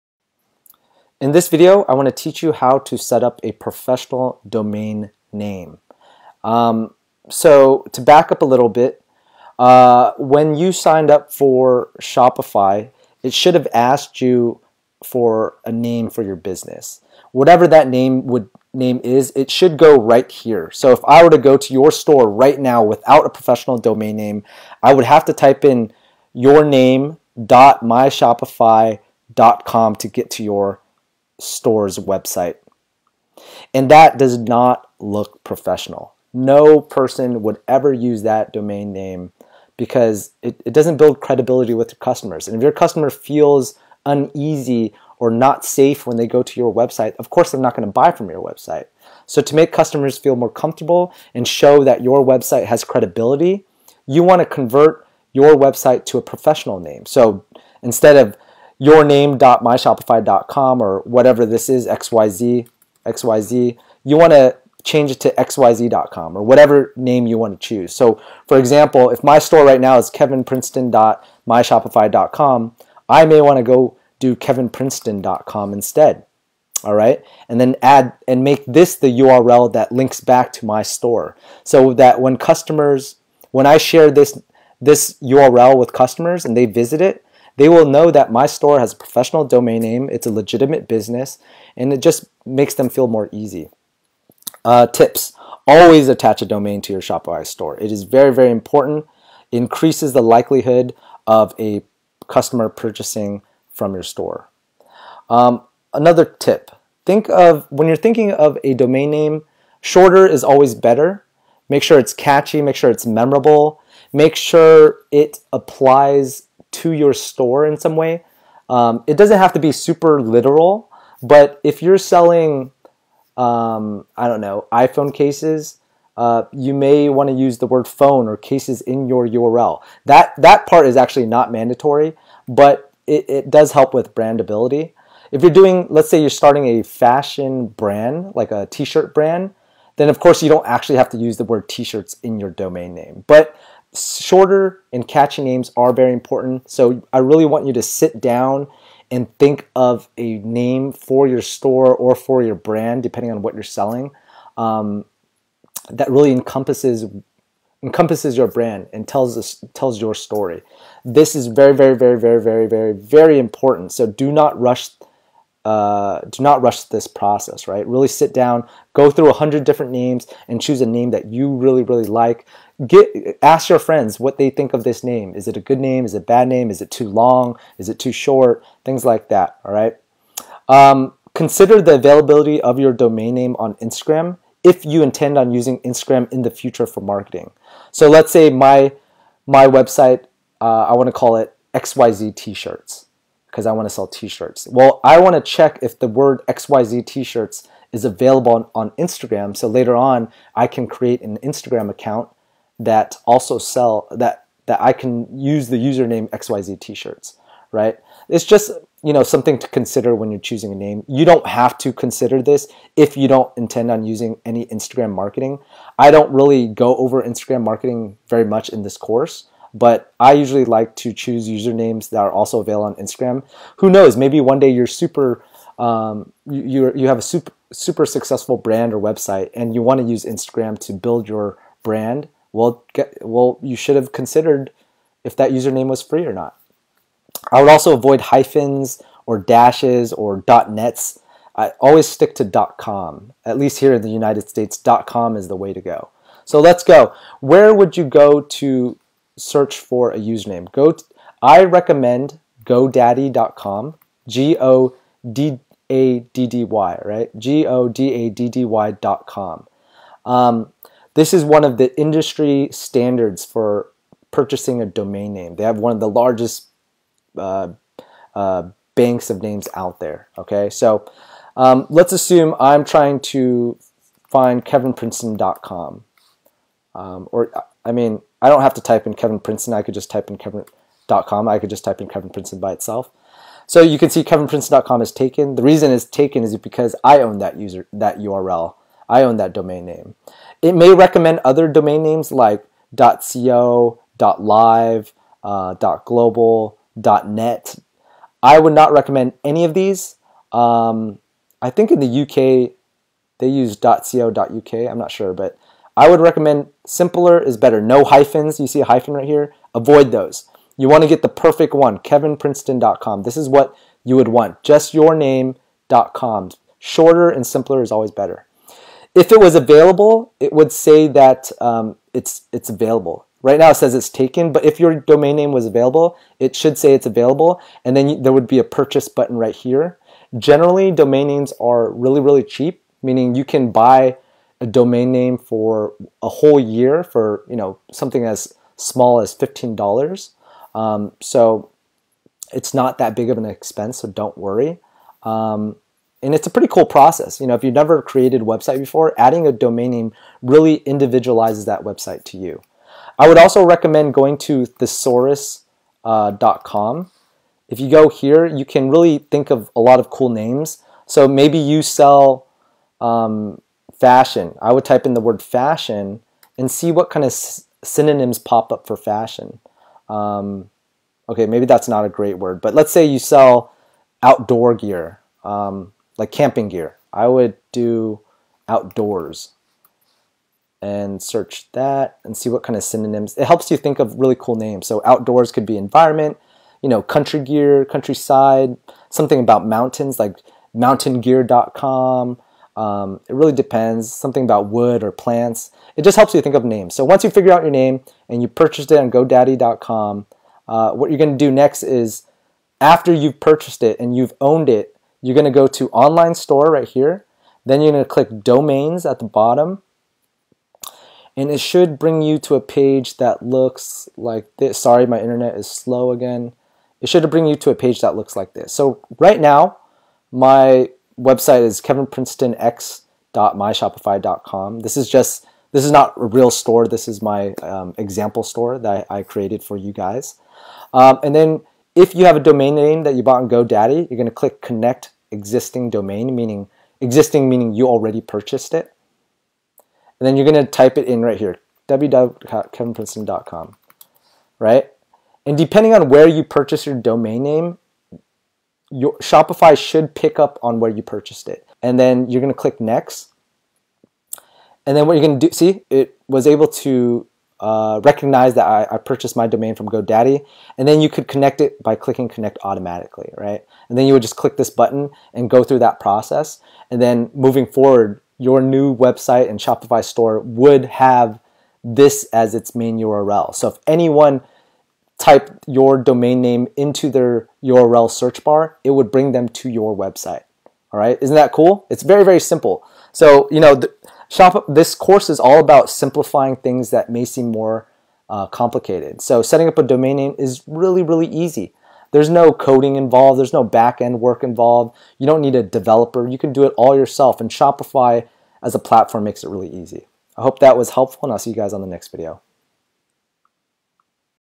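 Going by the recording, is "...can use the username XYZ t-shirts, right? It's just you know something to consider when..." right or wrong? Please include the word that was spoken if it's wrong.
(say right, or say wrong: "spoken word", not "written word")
right.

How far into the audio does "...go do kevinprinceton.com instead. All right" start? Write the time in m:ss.
1:13.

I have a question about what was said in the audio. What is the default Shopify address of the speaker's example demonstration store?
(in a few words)
kevinprincetonx.myshopify.com.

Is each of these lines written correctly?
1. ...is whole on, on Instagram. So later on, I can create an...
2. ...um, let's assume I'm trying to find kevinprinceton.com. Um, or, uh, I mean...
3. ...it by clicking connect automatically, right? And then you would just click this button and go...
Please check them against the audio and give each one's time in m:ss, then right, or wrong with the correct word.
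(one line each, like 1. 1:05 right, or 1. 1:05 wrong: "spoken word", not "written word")
1. 3:17 wrong: "available", not "whole"
2. 4:31 right
3. 7:41 right.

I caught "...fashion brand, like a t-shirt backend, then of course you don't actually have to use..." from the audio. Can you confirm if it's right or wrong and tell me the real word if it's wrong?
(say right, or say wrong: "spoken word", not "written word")
wrong: "brand", not "backend".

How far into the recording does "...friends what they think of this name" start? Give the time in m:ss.
2:53.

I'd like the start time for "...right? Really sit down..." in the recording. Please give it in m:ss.
2:47.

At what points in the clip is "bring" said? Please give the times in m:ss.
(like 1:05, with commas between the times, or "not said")
6:51, 6:57, 7:59.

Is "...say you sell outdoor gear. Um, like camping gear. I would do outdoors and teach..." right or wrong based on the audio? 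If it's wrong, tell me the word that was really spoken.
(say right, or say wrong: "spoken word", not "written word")
wrong: "search", not "teach".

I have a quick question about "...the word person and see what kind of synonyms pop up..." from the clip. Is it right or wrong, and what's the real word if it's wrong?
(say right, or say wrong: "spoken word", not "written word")
wrong: "fashion", not "person".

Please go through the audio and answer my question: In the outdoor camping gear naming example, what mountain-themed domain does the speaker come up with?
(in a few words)
mountaingear.com.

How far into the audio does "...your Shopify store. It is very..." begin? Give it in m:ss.
1:36.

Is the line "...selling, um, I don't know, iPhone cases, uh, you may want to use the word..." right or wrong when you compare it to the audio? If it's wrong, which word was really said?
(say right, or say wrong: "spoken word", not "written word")
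right.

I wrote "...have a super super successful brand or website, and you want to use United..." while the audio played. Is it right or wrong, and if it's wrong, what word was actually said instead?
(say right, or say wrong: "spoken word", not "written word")
wrong: "Instagram", not "United".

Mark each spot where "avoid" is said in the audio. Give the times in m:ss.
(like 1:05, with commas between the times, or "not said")
3:57, 5:09.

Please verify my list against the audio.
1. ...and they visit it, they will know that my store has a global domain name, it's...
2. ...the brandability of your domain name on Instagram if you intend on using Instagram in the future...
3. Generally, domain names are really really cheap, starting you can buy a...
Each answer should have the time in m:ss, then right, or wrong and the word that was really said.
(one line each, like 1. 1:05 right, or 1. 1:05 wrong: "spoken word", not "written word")
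1. 1:26 wrong: "professional", not "global"
2. 3:01 wrong: "availability", not "brandability"
3. 5:30 wrong: "meaning", not "starting".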